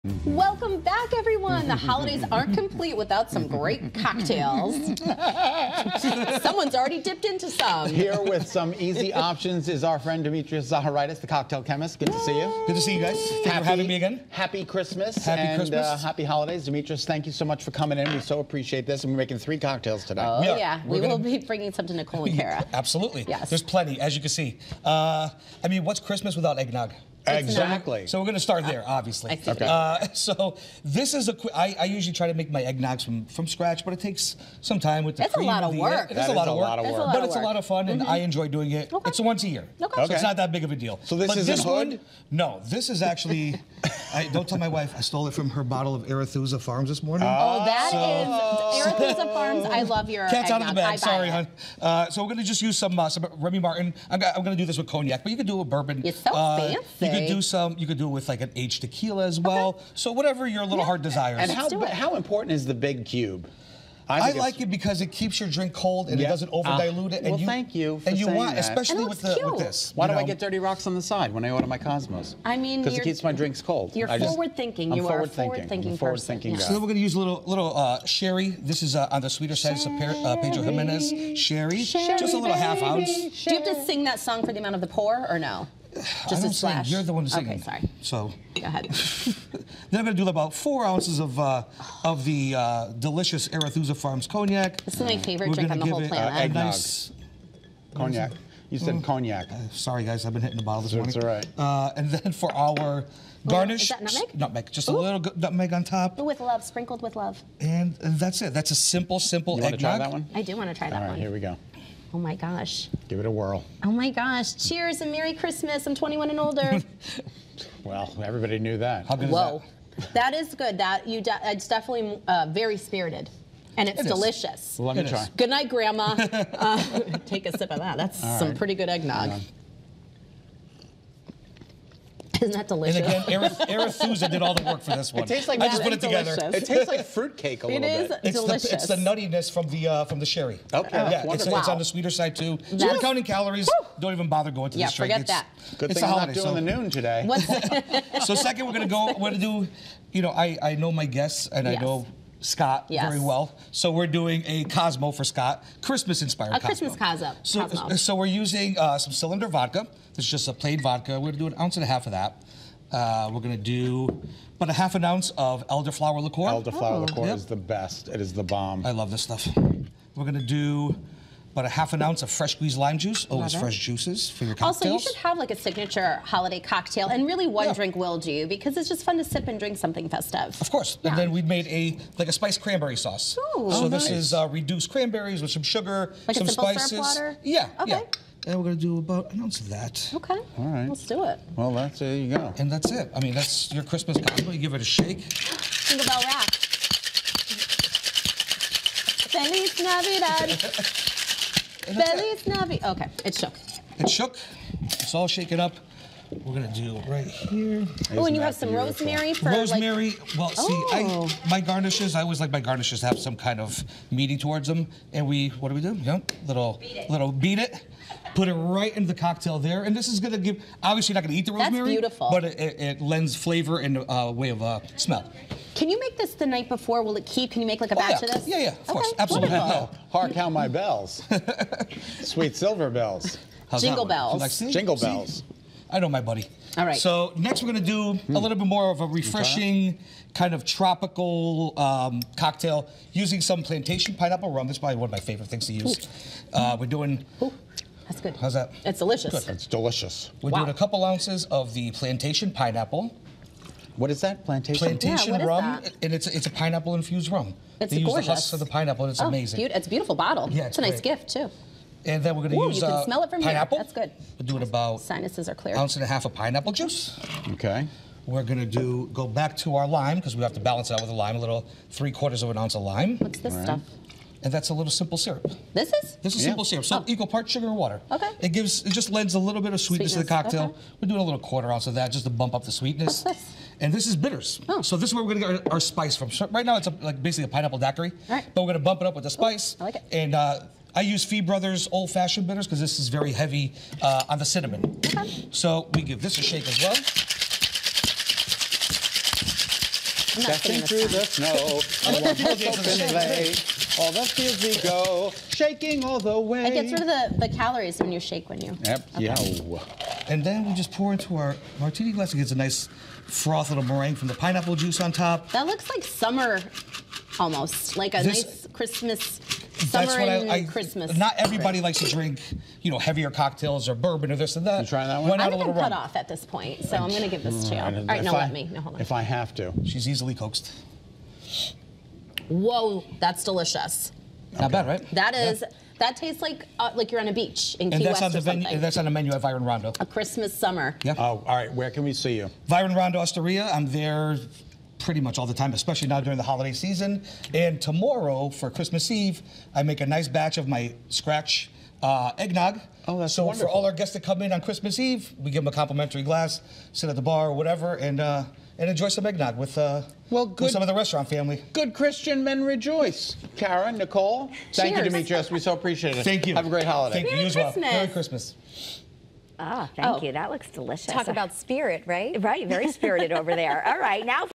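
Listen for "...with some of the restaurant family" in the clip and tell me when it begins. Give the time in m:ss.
6:00.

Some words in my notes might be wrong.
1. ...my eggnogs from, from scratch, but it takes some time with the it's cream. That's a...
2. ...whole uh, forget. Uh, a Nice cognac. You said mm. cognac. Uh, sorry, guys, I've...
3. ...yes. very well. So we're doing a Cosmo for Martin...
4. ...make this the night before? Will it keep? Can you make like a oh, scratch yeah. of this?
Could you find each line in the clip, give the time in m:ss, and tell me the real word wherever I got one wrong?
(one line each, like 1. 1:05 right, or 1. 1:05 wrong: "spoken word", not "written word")
1. 0:32 right
2. 1:35 wrong: "planet", not "forget"
3. 2:32 wrong: "Scott", not "Martin"
4. 3:45 wrong: "batch", not "scratch".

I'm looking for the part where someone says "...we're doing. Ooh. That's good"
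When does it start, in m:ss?
4:06.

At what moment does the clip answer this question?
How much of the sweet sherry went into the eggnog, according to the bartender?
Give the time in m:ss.
1:22.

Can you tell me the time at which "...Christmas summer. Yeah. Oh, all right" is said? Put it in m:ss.
5:40.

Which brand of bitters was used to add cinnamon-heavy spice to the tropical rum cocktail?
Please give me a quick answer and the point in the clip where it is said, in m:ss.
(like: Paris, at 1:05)
Fee Brothers, at 4:51.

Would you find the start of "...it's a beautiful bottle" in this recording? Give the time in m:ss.
4:19.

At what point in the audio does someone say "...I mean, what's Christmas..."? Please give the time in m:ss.
0:25.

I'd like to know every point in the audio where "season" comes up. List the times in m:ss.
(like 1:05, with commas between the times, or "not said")
5:46.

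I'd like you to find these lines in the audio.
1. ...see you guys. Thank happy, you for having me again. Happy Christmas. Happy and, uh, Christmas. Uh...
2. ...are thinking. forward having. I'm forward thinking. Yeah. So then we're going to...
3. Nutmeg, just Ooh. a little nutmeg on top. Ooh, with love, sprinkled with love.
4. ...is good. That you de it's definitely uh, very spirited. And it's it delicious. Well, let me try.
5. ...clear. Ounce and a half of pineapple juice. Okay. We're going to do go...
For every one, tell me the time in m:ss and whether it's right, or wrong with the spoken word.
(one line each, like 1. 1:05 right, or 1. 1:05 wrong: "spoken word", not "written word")
1. 0:12 right
2. 1:15 wrong: "thinking", not "having"
3. 1:44 right
4. 2:00 right
5. 4:25 right.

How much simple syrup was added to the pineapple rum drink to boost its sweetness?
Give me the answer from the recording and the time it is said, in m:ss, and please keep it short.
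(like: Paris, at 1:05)
quarter ounce, at 4:41.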